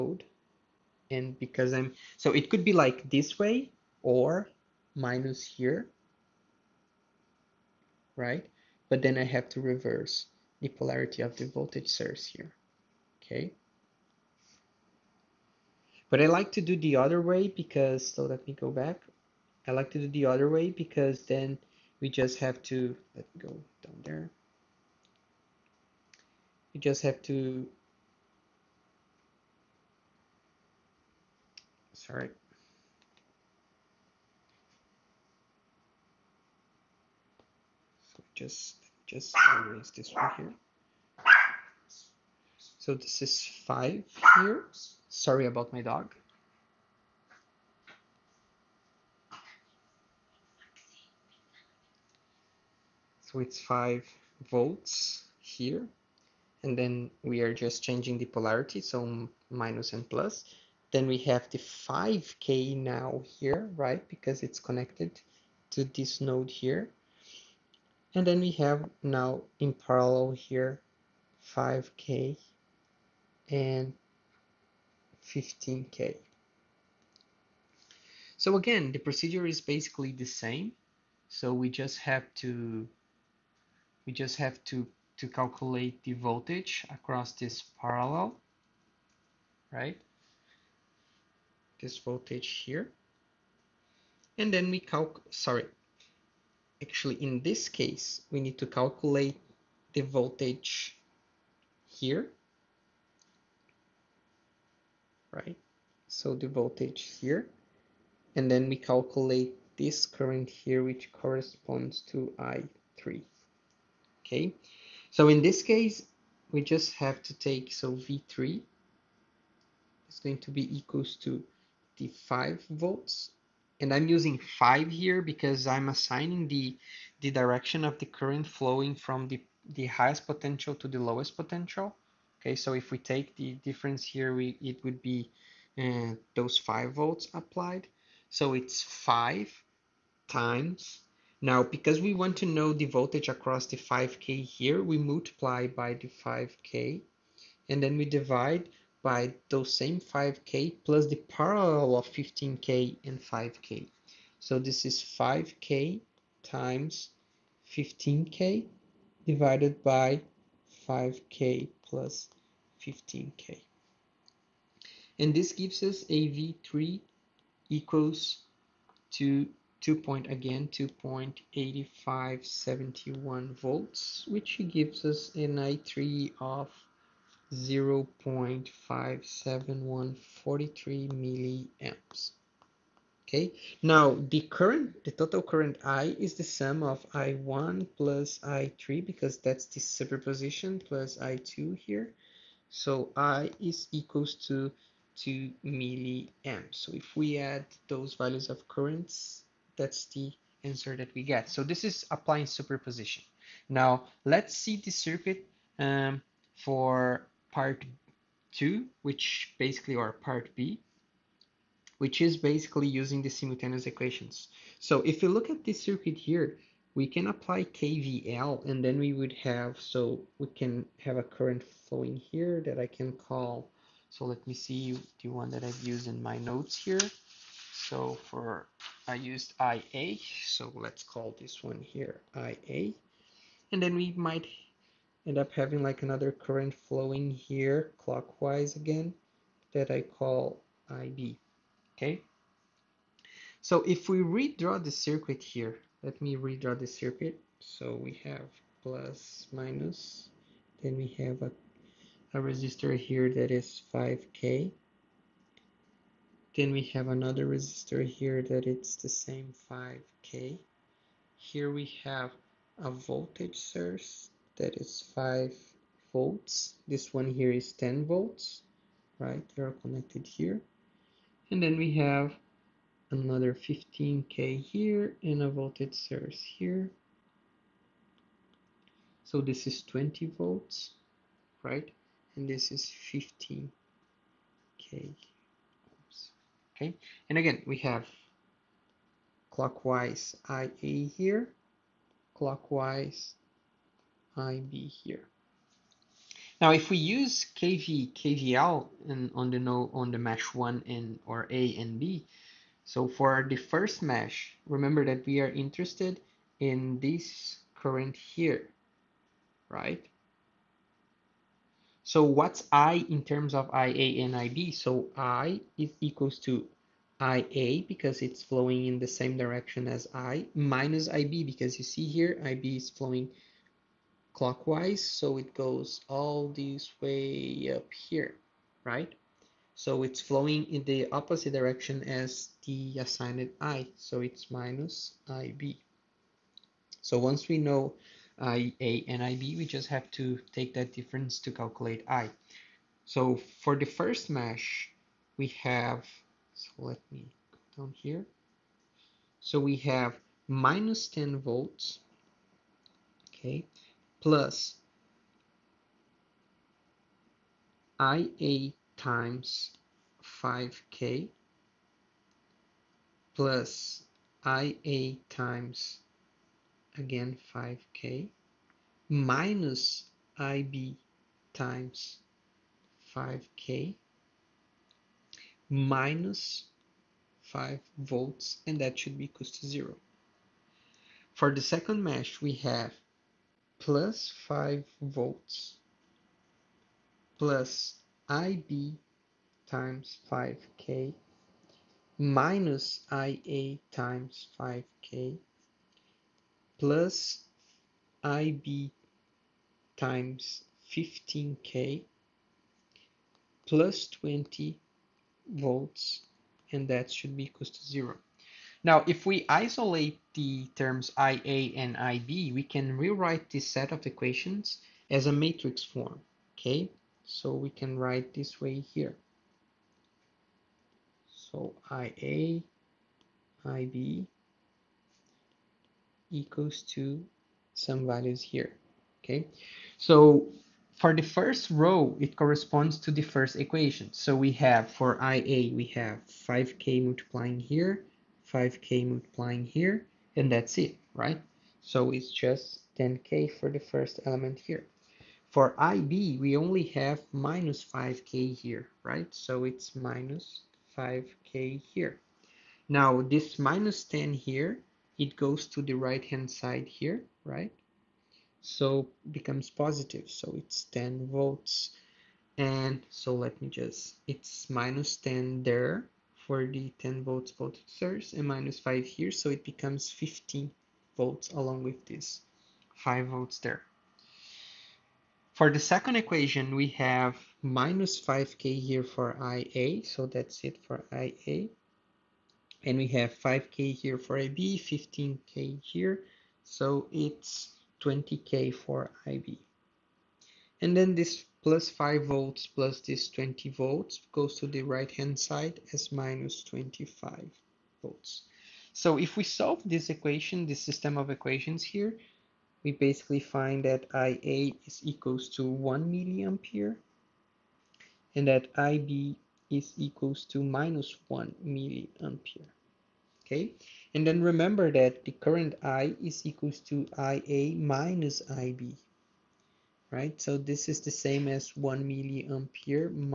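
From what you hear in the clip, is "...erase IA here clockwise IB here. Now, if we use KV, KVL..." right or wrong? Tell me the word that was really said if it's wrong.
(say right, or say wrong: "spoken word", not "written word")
wrong: "clockwise", not "erase".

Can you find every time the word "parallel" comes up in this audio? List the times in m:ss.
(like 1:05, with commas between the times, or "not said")
1:09, 1:27, 2:31.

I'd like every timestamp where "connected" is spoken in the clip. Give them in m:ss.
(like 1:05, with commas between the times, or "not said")
1:04, 4:29.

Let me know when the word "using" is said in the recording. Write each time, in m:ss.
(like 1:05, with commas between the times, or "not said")
2:04, 3:32.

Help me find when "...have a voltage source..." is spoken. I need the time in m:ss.
4:22.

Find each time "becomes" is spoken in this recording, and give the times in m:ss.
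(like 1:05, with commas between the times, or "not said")
7:39, 7:49.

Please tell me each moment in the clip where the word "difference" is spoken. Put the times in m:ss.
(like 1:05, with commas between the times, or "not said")
2:13, 5:40.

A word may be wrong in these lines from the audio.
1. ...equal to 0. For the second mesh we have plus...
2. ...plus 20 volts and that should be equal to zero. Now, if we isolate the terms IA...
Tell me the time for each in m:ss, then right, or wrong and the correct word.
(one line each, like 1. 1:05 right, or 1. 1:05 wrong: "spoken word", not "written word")
1. 6:19 right
2. 6:43 right.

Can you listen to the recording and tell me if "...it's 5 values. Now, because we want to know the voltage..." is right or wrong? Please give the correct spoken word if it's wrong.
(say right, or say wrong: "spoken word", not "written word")
wrong: "times", not "values".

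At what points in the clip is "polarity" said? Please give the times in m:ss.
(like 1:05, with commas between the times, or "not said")
0:10, 0:58.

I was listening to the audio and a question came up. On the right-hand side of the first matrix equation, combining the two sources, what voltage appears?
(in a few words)
15 volts.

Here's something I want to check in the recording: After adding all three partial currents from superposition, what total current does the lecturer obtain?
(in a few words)
2 milliamps.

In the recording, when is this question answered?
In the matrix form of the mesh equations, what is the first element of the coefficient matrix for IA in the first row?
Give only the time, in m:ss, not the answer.
7:22.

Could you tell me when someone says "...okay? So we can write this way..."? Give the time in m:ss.
6:56.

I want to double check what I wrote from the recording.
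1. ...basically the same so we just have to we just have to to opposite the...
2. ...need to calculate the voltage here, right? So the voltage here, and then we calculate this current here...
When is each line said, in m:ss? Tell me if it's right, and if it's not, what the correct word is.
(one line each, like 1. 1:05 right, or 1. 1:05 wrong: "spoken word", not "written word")
1. 1:19 wrong: "calculate", not "opposite"
2. 1:38 right.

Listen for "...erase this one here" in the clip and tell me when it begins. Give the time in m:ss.
0:39.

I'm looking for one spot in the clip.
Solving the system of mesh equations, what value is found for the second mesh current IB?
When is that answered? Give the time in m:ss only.
8:30.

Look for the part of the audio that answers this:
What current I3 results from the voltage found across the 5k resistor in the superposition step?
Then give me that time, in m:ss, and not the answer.
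2:57.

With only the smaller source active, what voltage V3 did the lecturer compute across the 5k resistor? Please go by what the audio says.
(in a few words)
2.8571 volts.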